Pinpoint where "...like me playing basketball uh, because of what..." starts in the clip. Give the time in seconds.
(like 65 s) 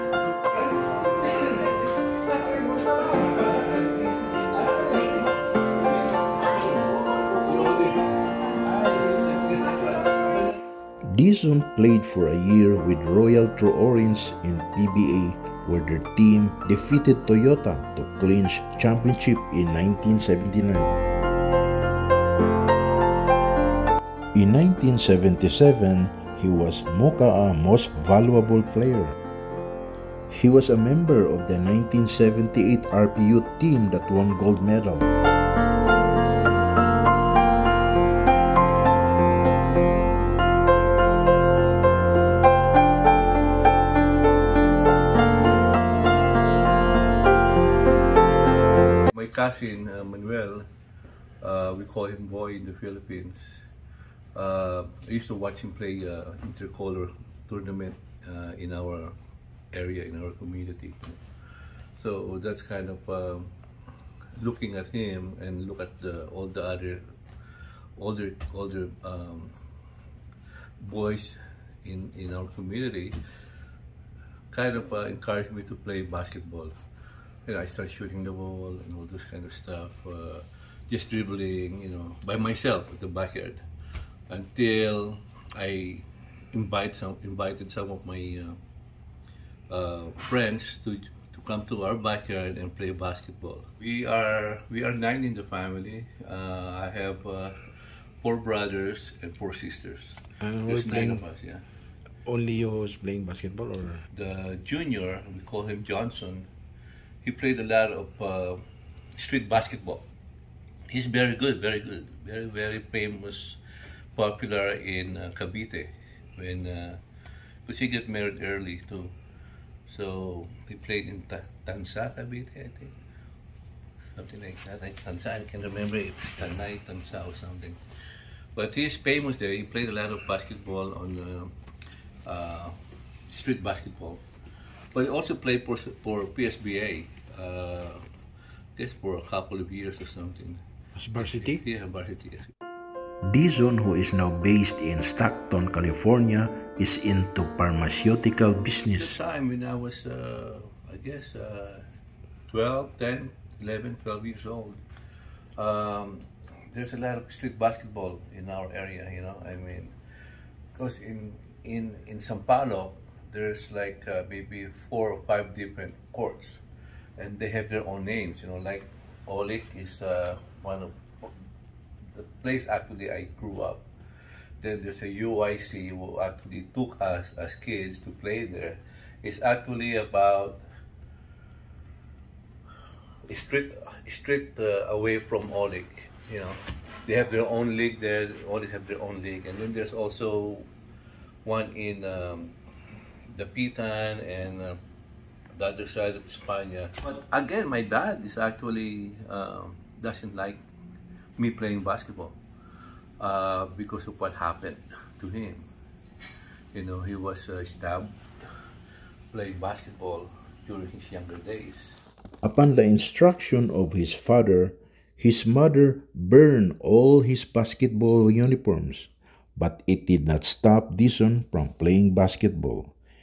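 200 s.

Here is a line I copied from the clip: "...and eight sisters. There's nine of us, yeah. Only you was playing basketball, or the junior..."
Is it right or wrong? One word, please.
wrong.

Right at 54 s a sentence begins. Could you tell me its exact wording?
Uh, I used to watch him play uh, intercolor tournament uh, in our area, in our community.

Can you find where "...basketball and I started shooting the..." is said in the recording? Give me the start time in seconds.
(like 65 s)
76 s.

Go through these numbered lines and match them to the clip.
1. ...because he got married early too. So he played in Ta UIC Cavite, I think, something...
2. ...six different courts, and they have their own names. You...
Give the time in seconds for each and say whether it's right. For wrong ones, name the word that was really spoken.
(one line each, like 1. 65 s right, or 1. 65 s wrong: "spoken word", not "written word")
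1. 117 s wrong: "Tanza", not "UIC"
2. 165 s wrong: "five", not "six".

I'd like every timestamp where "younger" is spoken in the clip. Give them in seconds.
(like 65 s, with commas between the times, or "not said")
211 s.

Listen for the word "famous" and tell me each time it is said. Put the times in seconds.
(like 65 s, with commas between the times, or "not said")
112 s, 128 s.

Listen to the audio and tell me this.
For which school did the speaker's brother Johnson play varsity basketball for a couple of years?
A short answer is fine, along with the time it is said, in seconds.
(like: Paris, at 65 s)
PSBA, at 136 s.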